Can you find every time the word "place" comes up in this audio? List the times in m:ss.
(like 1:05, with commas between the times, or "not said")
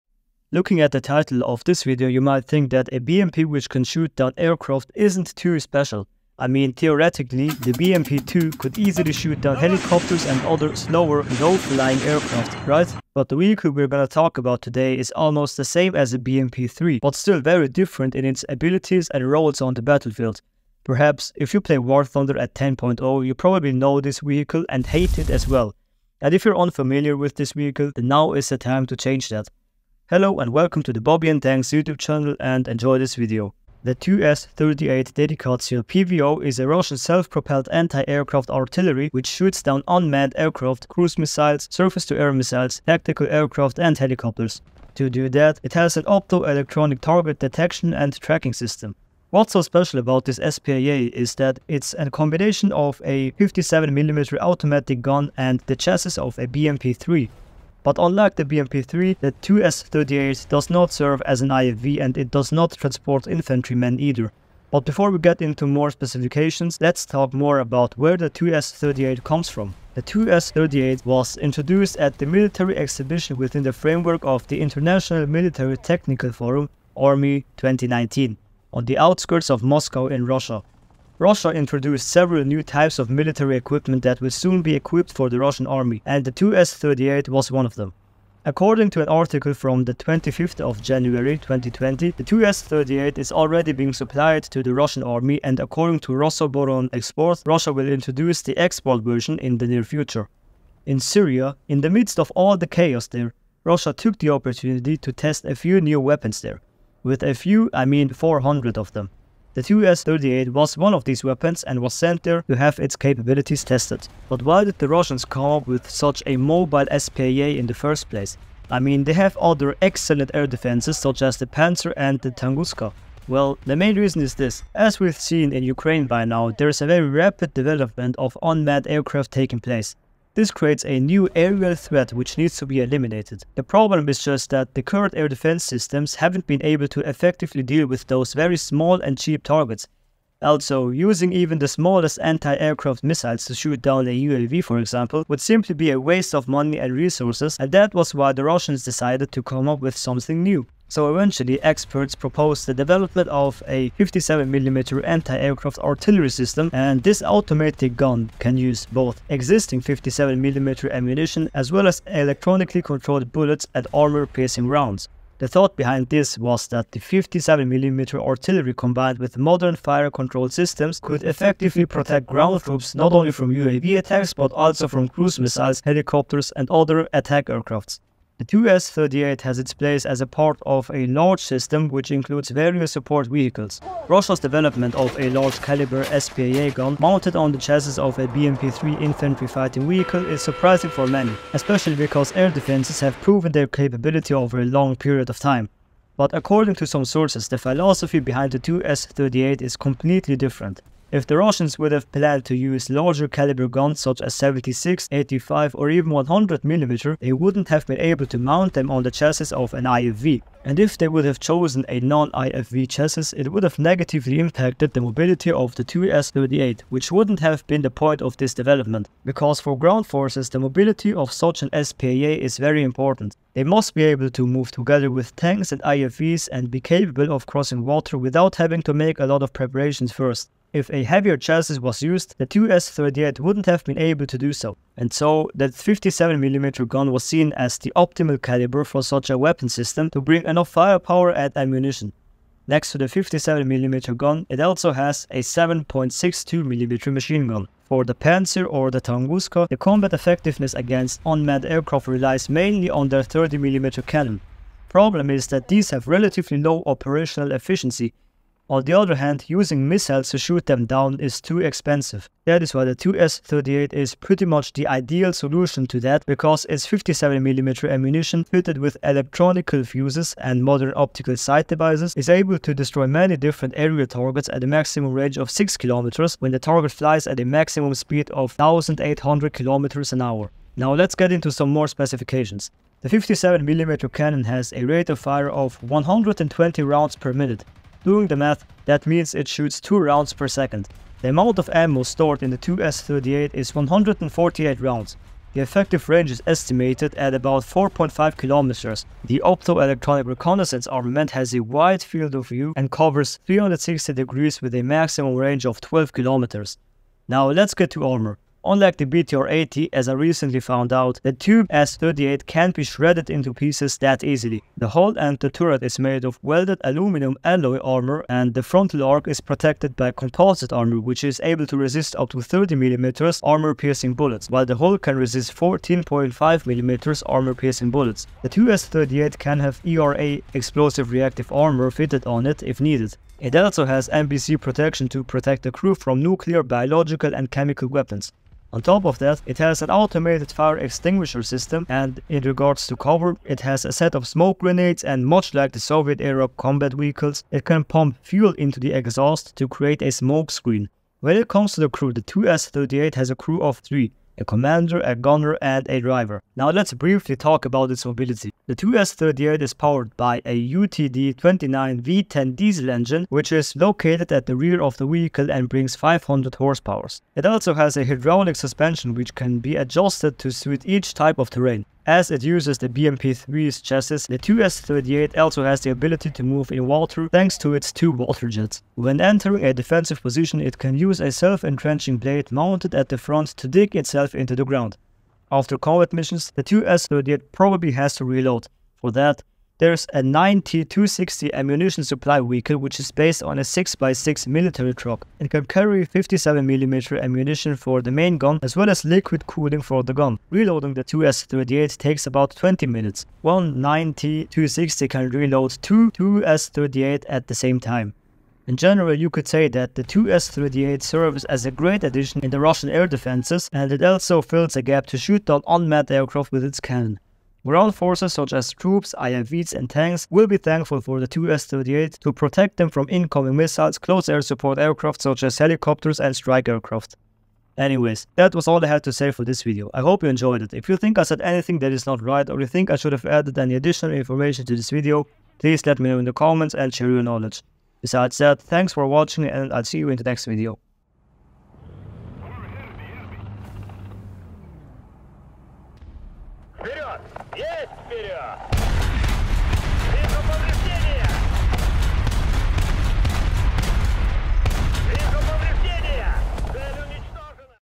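1:58, 2:09, 2:59.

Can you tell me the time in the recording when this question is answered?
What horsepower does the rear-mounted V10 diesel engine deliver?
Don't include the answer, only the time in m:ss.
6:05.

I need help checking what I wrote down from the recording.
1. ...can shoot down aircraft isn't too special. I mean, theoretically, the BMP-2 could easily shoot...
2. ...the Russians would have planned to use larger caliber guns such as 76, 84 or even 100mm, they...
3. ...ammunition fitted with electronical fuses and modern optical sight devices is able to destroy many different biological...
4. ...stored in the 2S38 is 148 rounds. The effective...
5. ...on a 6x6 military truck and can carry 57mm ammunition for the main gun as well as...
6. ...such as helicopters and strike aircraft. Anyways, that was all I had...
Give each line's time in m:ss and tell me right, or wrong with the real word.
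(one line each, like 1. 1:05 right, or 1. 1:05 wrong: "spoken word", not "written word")
1. 0:03 right
2. 3:21 wrong: "85", not "84"
3. 4:27 wrong: "aerial", not "biological"
4. 4:52 right
5. 6:33 right
6. 7:05 right.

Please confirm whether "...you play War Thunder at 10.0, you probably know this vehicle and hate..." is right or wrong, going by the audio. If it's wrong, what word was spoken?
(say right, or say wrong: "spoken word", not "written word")
right.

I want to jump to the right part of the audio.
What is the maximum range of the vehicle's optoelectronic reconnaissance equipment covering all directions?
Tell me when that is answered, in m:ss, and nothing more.
5:05.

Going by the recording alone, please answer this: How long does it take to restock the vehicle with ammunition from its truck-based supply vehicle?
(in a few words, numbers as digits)
20 minutes.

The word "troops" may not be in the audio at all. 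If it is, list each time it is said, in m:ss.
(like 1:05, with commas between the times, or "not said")
2:52, 6:58.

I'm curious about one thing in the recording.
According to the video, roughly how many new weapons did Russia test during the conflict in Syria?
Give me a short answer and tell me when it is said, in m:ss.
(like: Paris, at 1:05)
400, at 1:48.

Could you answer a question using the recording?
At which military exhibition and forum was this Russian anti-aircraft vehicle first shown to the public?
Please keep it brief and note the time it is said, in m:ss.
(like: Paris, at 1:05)
ARMY 2019, at 1:16.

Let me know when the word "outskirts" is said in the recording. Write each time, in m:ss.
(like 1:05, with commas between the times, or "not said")
1:18.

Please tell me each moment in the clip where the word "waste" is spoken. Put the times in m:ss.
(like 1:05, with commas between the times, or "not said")
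2:25.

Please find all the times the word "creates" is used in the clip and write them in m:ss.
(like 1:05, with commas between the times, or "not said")
2:10, 5:49.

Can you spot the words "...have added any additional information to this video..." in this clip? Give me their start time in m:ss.
7:13.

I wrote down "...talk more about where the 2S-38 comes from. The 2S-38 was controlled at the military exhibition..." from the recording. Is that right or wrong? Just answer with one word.
wrong.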